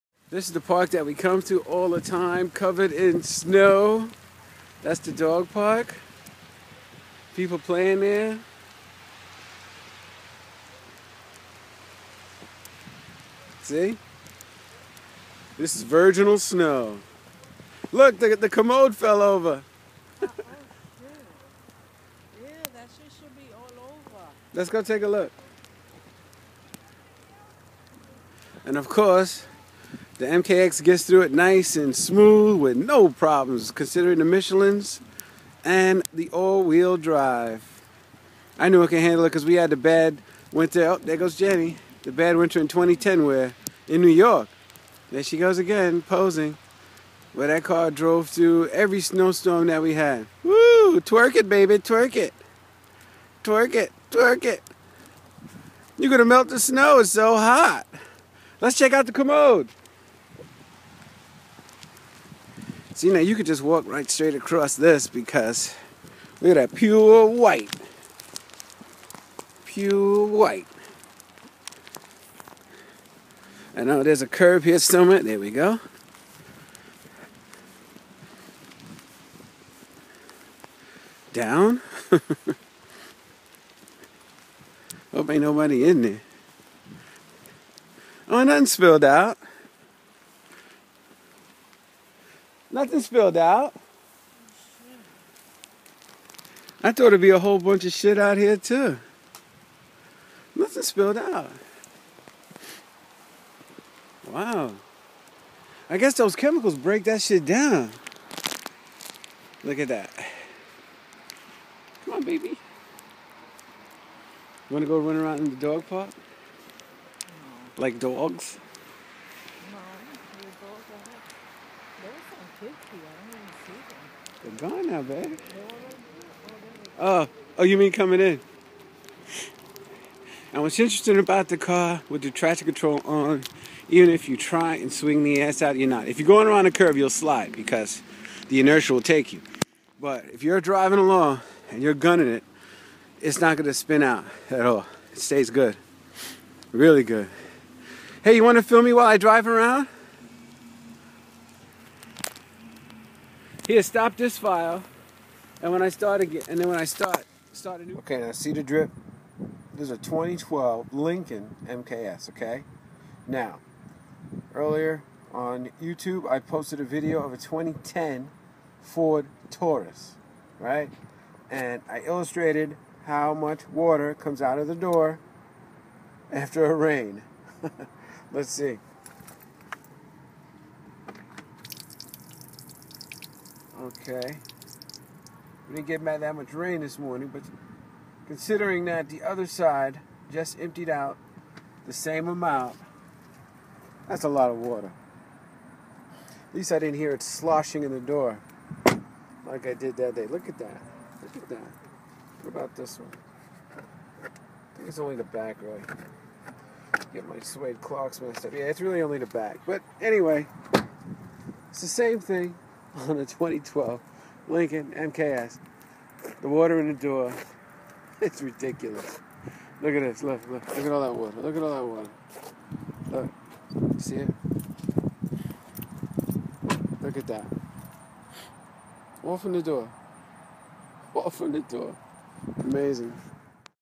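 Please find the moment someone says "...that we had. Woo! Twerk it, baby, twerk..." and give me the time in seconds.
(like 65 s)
49 s.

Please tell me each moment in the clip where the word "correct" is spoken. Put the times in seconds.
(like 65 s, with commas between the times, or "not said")
not said.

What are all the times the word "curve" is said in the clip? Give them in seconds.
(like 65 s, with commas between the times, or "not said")
74 s, 136 s.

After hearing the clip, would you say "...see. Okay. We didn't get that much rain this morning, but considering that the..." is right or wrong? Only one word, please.
right.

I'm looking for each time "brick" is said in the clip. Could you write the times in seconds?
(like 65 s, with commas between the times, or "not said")
not said.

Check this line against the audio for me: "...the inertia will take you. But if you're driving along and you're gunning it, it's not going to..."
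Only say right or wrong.
right.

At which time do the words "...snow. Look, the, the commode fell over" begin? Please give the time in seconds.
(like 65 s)
16 s.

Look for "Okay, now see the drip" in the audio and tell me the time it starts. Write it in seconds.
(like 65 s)
157 s.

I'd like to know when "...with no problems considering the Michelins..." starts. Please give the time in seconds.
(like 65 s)
32 s.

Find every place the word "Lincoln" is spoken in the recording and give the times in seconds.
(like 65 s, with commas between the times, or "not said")
160 s, 214 s.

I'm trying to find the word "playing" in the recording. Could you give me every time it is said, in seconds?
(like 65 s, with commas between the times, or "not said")
7 s.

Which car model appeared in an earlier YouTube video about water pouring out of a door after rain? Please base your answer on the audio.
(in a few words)
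2010 Ford Taurus.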